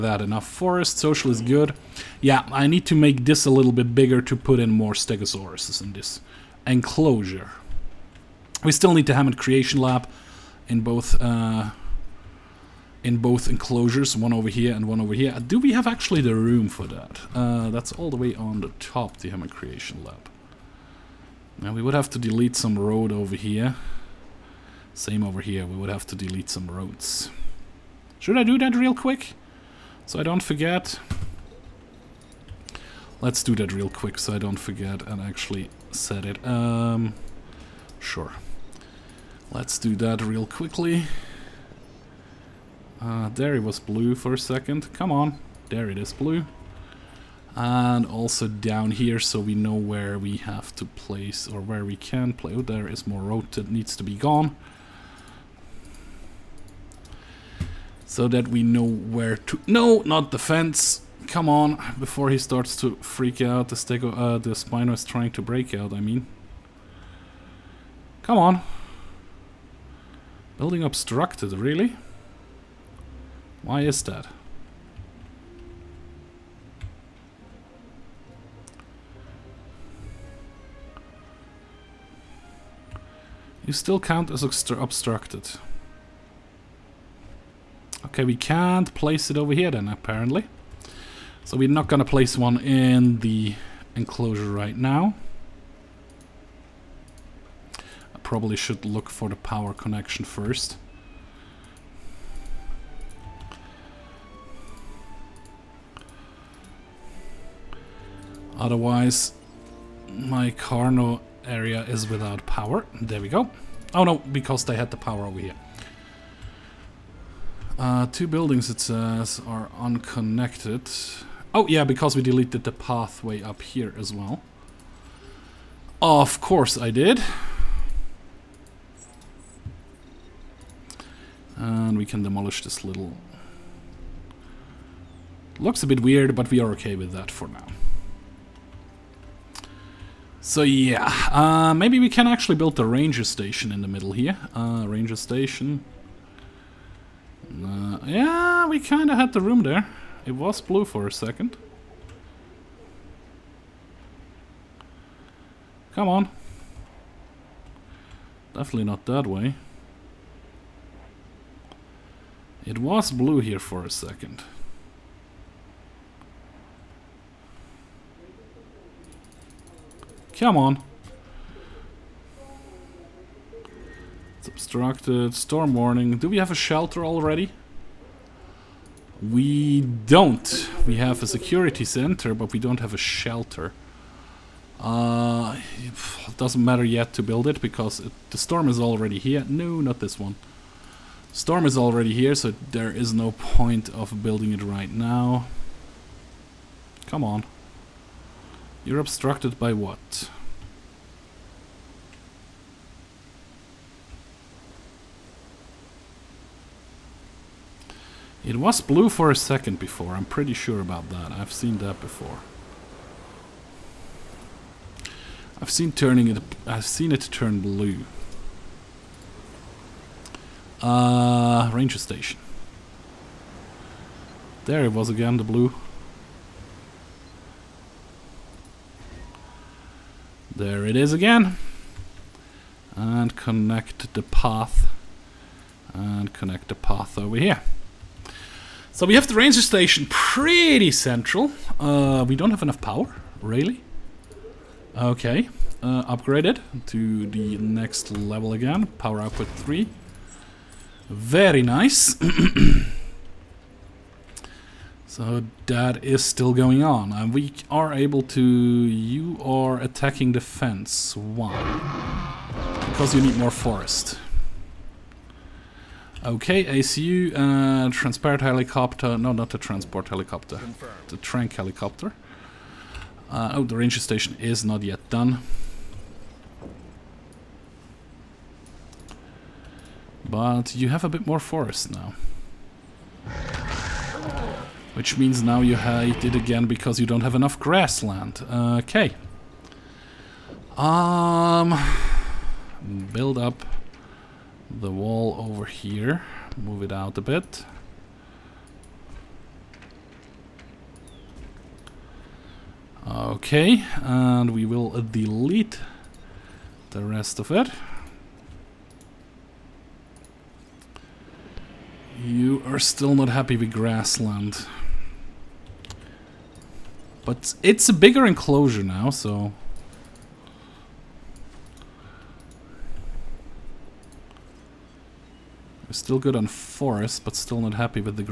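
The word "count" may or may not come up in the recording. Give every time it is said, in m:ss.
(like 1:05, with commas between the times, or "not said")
1:23.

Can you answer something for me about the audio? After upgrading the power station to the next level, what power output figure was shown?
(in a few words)
3.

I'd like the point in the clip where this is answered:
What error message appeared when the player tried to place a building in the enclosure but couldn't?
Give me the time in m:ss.
1:10.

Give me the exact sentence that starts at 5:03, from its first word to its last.
Okay, and we will delete the rest of it.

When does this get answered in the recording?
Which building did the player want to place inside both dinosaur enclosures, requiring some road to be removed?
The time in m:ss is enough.
0:19.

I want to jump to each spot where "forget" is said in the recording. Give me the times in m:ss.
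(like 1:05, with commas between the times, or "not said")
0:30, 0:34.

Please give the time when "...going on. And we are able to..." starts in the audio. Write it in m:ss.
4:16.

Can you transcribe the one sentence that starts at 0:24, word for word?
Same over here, we would have to delete some roads.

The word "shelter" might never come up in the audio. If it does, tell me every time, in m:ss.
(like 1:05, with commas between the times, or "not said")
2:56, 3:02.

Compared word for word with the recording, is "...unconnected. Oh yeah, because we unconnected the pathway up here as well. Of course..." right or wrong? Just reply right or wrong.
wrong.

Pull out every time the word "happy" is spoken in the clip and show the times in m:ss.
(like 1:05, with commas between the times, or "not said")
5:13, 5:27.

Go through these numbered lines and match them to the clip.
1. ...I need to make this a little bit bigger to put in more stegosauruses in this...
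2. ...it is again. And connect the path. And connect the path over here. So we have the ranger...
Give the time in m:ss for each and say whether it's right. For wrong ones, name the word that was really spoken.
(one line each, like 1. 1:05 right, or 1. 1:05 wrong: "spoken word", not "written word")
1. 0:02 right
2. 3:50 right.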